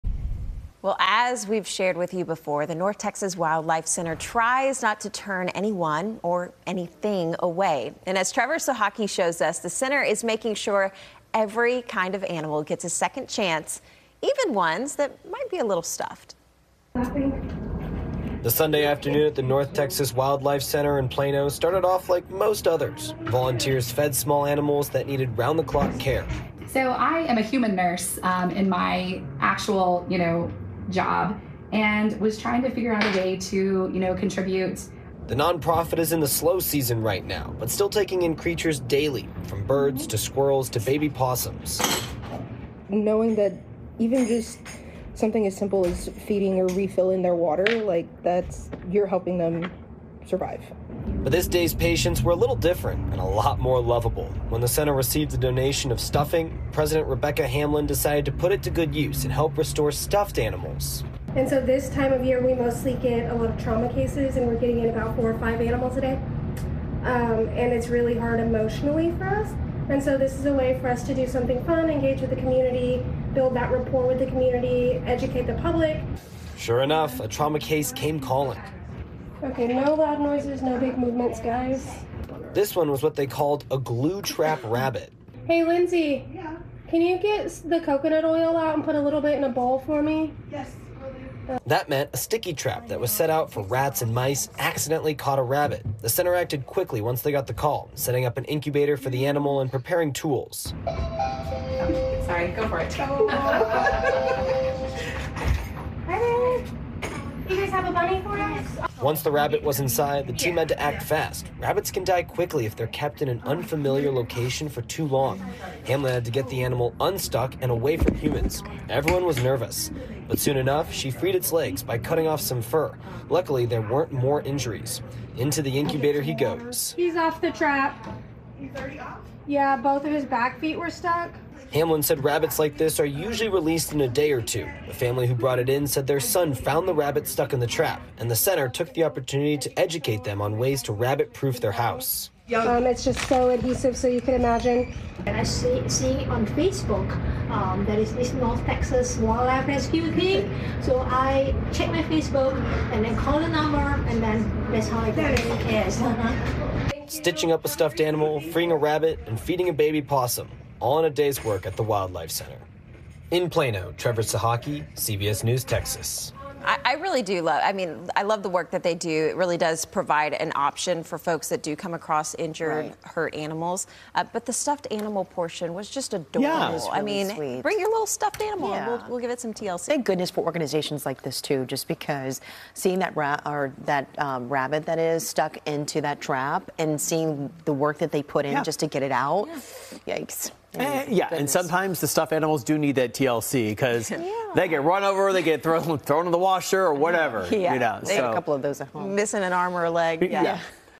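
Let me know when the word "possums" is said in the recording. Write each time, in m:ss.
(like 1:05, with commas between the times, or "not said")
0:41, 2:40.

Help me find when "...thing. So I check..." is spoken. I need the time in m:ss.
2:30.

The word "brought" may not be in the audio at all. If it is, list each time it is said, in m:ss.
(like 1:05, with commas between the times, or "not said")
2:15.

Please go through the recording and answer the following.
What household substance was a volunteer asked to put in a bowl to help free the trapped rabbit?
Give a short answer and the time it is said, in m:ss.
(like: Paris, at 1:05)
Coconut oil, at 1:27.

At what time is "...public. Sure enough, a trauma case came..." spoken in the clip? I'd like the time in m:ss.
1:15.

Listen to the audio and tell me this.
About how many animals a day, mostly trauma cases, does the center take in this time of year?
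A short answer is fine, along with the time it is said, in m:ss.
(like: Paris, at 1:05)
4 or 5, at 1:05.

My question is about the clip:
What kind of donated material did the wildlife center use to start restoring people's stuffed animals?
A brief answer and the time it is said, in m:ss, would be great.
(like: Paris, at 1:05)
Stuffing, at 0:55.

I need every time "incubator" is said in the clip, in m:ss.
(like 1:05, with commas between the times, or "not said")
1:38, 2:05.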